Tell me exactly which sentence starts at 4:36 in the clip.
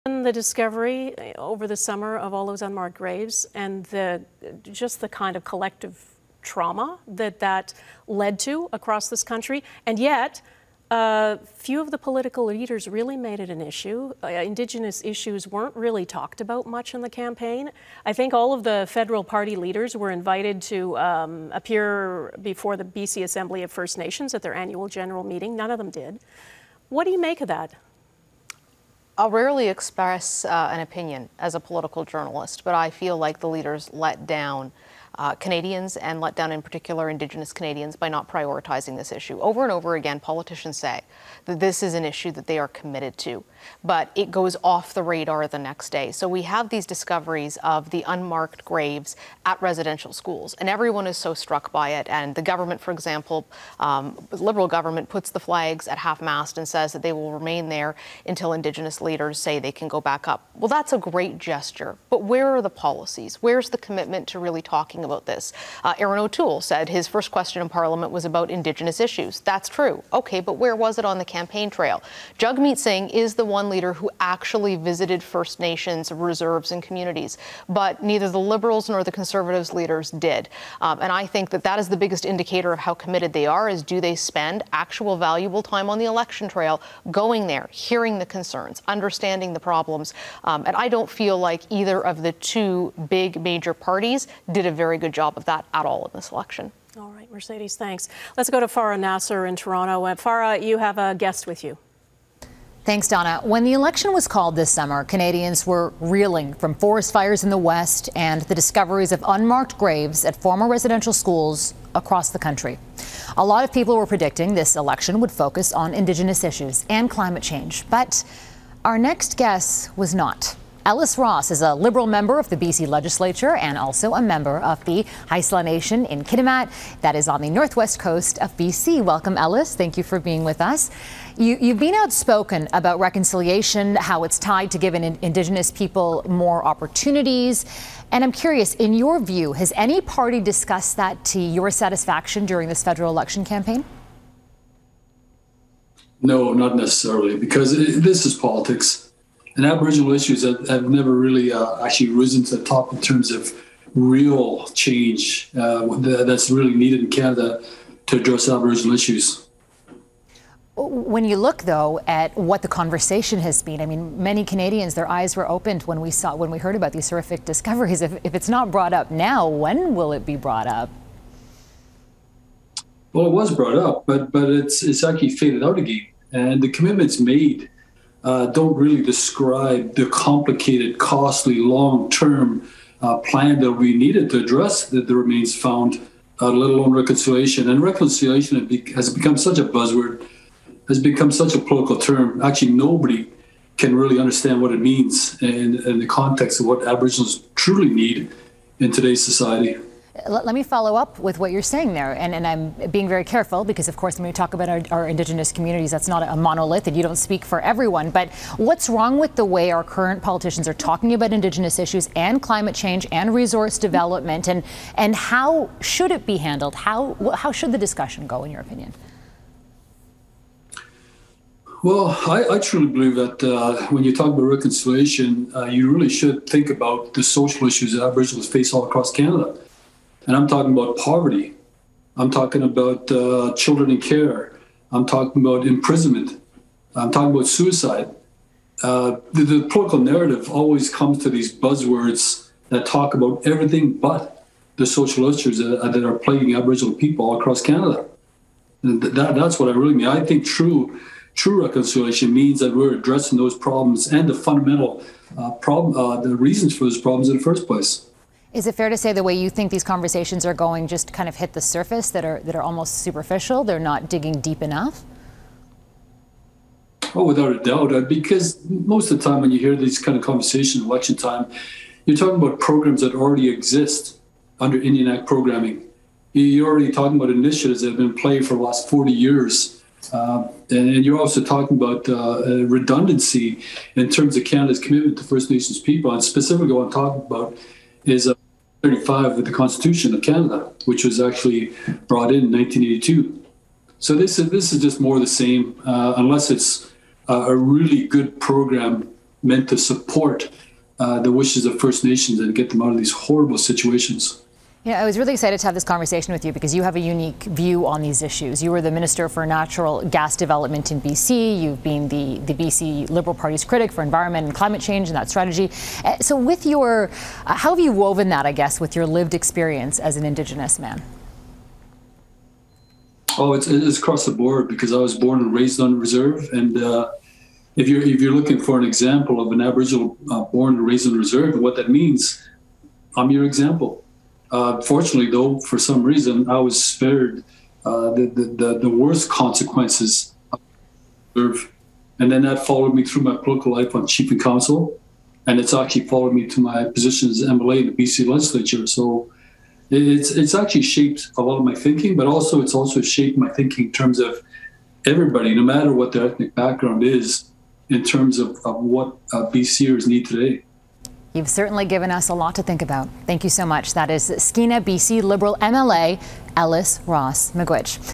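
You're already talking about initiatives that have been in play for the last 40 years.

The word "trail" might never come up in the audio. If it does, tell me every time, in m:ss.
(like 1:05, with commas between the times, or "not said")
1:11, 1:26.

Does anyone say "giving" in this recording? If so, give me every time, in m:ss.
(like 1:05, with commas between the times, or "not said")
2:14.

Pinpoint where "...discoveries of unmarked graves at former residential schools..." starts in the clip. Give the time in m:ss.
1:48.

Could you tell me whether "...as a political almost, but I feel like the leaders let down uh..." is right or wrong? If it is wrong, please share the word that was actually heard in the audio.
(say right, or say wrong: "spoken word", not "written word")
wrong: "journalist", not "almost".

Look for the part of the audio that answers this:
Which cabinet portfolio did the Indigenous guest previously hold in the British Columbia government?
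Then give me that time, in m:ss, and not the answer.
5:08.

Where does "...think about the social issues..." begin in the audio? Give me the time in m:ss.
3:46.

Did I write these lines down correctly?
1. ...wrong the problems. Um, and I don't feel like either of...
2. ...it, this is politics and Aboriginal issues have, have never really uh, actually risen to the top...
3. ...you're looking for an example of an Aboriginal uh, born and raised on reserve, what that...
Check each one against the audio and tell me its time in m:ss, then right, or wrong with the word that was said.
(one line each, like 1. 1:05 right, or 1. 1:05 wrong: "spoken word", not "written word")
1. 1:28 wrong: "understanding", not "wrong"
2. 2:27 right
3. 5:28 right.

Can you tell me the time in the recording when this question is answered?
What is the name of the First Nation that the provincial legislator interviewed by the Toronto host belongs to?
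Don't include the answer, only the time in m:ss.
2:05.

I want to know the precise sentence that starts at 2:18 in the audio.
And I'm curious, in your view, has any party discussed that to your satisfaction during this federal election campaign?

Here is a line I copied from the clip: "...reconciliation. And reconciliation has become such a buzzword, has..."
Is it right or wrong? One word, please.
right.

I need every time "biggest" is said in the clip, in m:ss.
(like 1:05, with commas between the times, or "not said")
1:21.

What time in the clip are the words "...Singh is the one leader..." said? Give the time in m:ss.
1:12.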